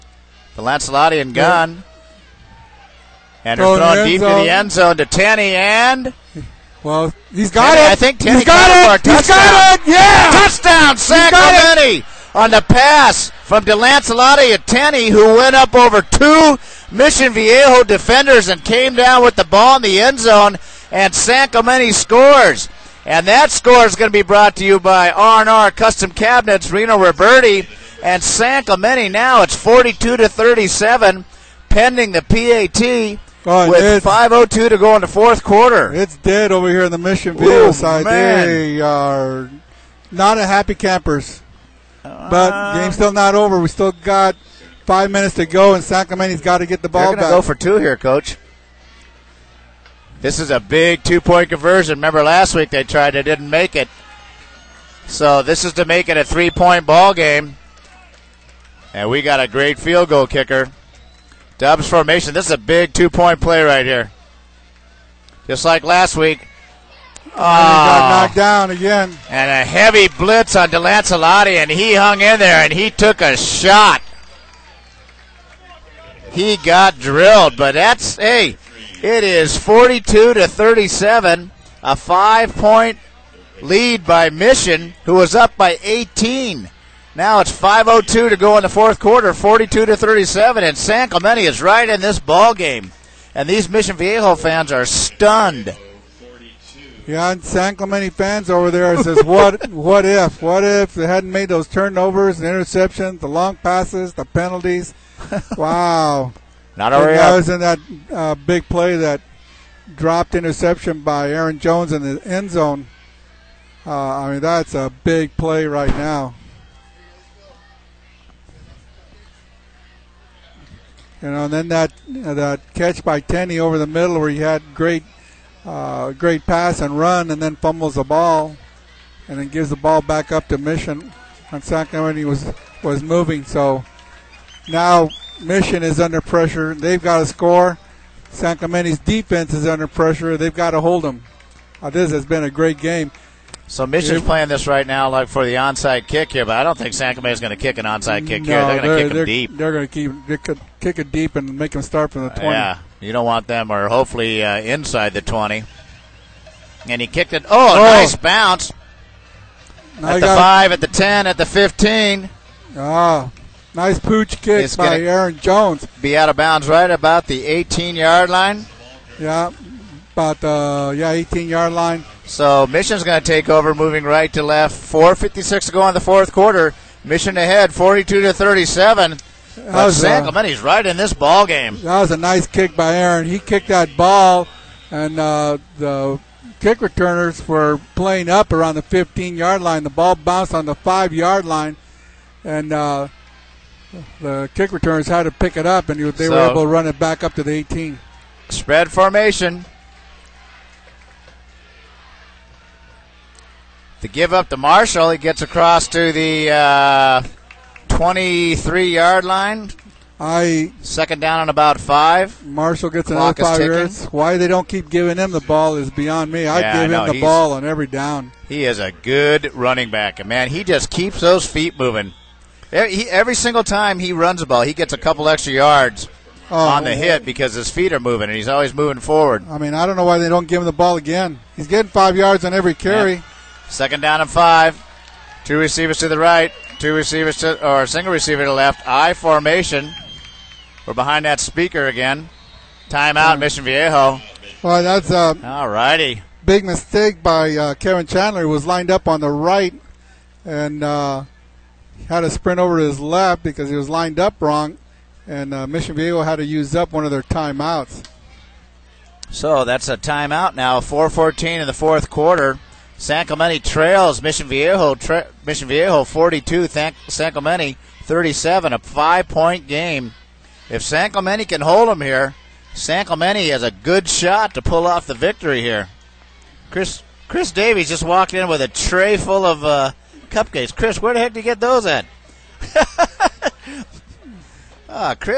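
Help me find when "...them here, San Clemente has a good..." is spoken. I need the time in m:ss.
4:31.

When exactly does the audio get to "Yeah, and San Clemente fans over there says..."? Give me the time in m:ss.
1:37.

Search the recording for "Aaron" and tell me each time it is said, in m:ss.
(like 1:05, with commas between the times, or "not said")
1:51, 2:44, 3:02.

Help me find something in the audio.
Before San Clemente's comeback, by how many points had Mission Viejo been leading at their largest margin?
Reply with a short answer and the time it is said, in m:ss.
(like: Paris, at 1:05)
18, at 1:25.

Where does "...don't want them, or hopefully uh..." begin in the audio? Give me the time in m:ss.
2:33.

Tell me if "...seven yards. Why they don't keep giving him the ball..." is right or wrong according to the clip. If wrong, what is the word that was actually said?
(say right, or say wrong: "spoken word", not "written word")
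wrong: "five", not "seven".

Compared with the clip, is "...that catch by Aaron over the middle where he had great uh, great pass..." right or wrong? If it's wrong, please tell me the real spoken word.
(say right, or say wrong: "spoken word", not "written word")
wrong: "Tenney", not "Aaron".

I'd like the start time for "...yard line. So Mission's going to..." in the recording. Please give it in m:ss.
2:51.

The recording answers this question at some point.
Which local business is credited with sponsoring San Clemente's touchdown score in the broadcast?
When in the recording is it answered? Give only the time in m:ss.
0:25.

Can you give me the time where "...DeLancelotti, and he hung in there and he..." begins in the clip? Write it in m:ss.
1:10.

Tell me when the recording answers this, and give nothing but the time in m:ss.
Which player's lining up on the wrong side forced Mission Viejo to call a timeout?
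4:07.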